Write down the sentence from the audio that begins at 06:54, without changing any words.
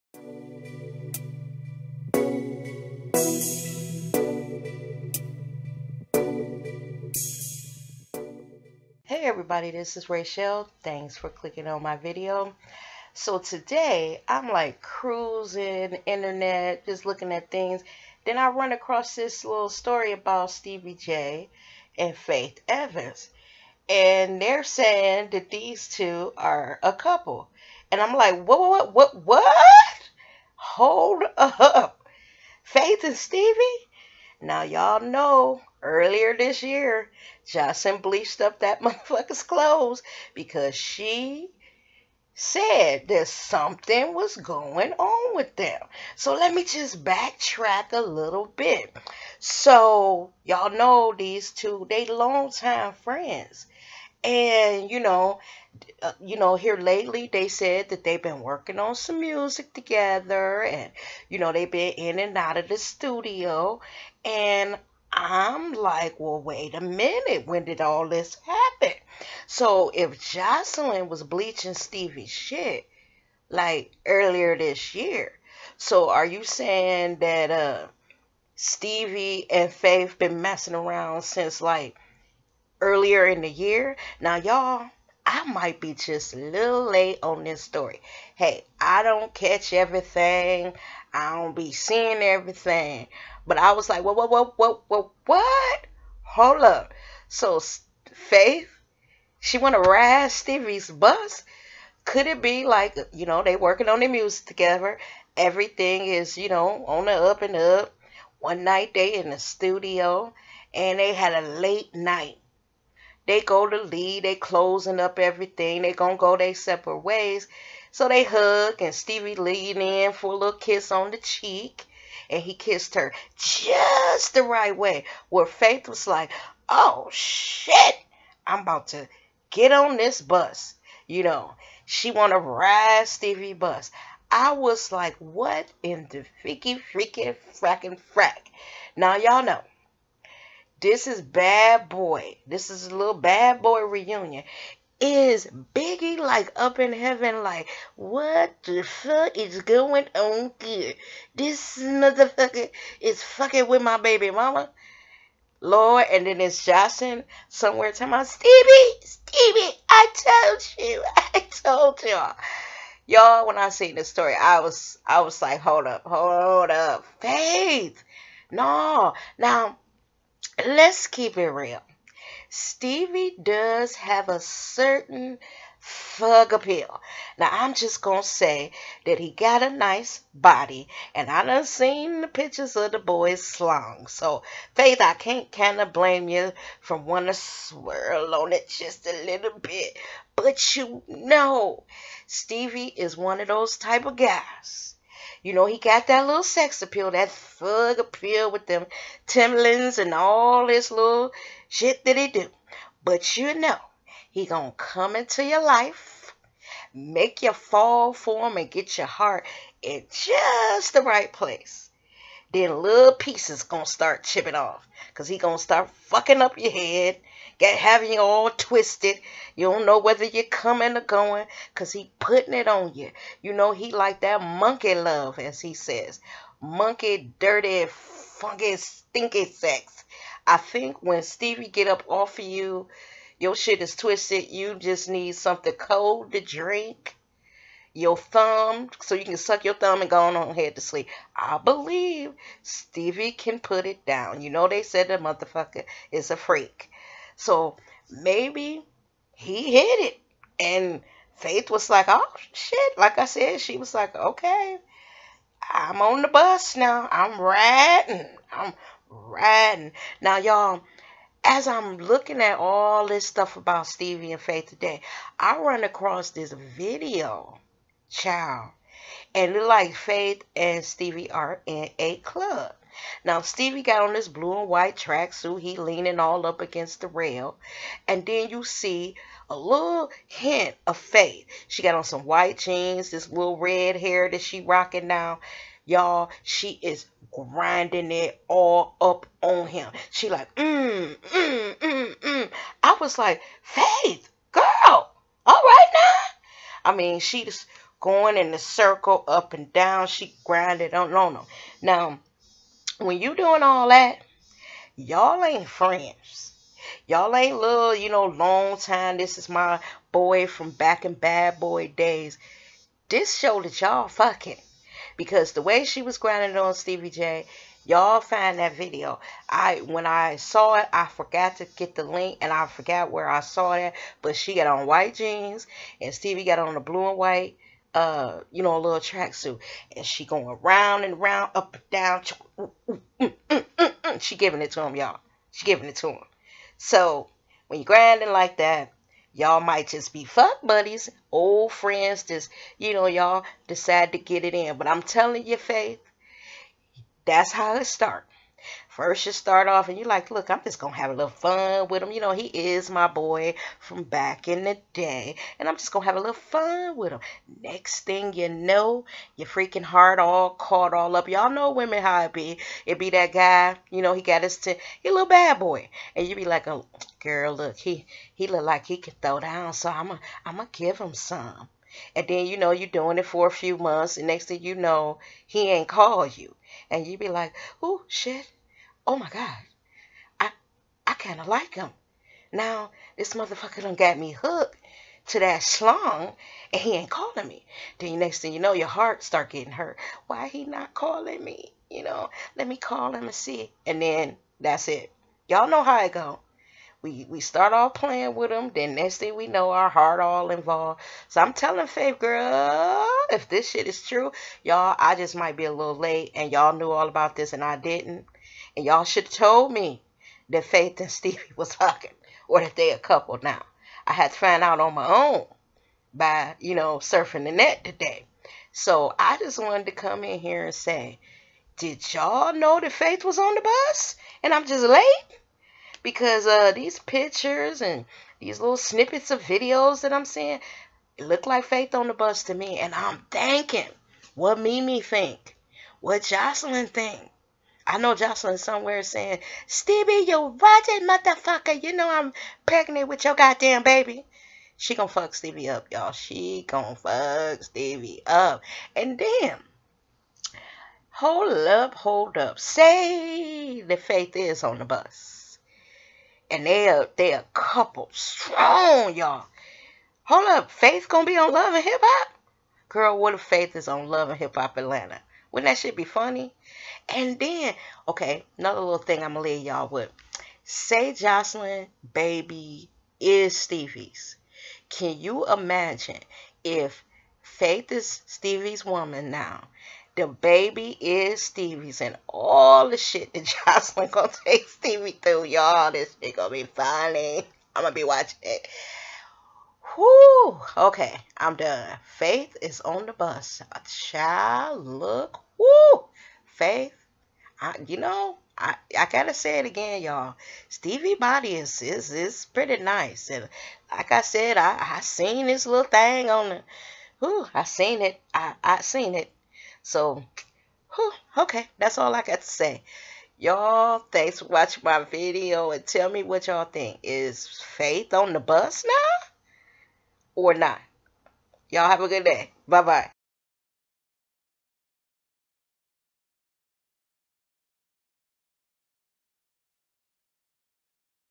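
I had to find out on my own by you know surfing the net today.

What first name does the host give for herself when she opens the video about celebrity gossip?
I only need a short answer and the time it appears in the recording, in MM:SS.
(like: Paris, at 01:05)
Rachelle, at 00:10.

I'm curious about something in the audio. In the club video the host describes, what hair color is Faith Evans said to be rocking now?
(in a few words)
red.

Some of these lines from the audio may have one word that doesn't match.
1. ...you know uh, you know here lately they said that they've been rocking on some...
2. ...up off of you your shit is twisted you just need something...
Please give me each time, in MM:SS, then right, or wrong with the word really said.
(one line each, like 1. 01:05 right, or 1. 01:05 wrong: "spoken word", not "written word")
1. 00:54 wrong: "working", not "rocking"
2. 03:51 right.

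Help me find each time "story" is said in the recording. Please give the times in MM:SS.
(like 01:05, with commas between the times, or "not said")
00:19, 01:27, 02:44.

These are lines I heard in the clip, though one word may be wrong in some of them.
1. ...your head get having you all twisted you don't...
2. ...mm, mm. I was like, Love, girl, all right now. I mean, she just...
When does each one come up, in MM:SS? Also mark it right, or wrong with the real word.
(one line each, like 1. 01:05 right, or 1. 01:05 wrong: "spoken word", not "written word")
1. 03:36 right
2. 04:51 wrong: "Faith", not "Love".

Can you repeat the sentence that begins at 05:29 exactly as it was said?
And she going round and round, up and down.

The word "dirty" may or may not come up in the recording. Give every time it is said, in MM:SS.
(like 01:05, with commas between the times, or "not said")
03:47.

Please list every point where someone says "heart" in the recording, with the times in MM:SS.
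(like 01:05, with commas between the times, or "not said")
03:29, 05:59, 06:28, 06:39.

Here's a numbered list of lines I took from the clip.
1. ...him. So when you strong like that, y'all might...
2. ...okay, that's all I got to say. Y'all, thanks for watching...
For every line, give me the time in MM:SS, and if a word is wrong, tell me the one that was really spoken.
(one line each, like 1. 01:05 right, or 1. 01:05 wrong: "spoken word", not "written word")
1. 05:36 wrong: "grinding", not "strong"
2. 08:31 right.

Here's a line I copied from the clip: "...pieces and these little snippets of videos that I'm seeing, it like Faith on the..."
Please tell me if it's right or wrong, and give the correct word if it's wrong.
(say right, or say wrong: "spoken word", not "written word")
wrong: "pictures", not "pieces".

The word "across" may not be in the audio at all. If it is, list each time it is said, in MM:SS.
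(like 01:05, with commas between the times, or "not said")
00:18, 04:25.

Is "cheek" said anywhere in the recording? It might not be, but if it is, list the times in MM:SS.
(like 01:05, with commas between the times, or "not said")
02:01.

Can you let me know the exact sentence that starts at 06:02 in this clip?
It be that guy, you know, he got his, t- he a little bad boy.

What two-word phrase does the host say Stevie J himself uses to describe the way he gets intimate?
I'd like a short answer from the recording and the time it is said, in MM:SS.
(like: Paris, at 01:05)
monkey love, at 03:44.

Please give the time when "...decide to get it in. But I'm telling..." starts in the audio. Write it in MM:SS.
05:43.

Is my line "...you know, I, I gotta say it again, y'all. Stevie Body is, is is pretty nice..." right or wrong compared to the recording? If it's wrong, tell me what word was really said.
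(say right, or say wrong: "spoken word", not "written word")
right.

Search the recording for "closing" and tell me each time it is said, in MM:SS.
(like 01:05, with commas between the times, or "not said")
01:54.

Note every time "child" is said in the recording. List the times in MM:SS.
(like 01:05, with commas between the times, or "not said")
04:28, 08:13.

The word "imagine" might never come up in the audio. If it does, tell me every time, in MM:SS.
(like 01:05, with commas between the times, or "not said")
07:55.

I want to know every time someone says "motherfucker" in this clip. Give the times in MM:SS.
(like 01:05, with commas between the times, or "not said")
00:38, 02:31, 04:05, 06:23, 07:21.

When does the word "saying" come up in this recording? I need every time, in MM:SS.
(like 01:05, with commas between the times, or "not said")
00:24, 01:16, 07:19.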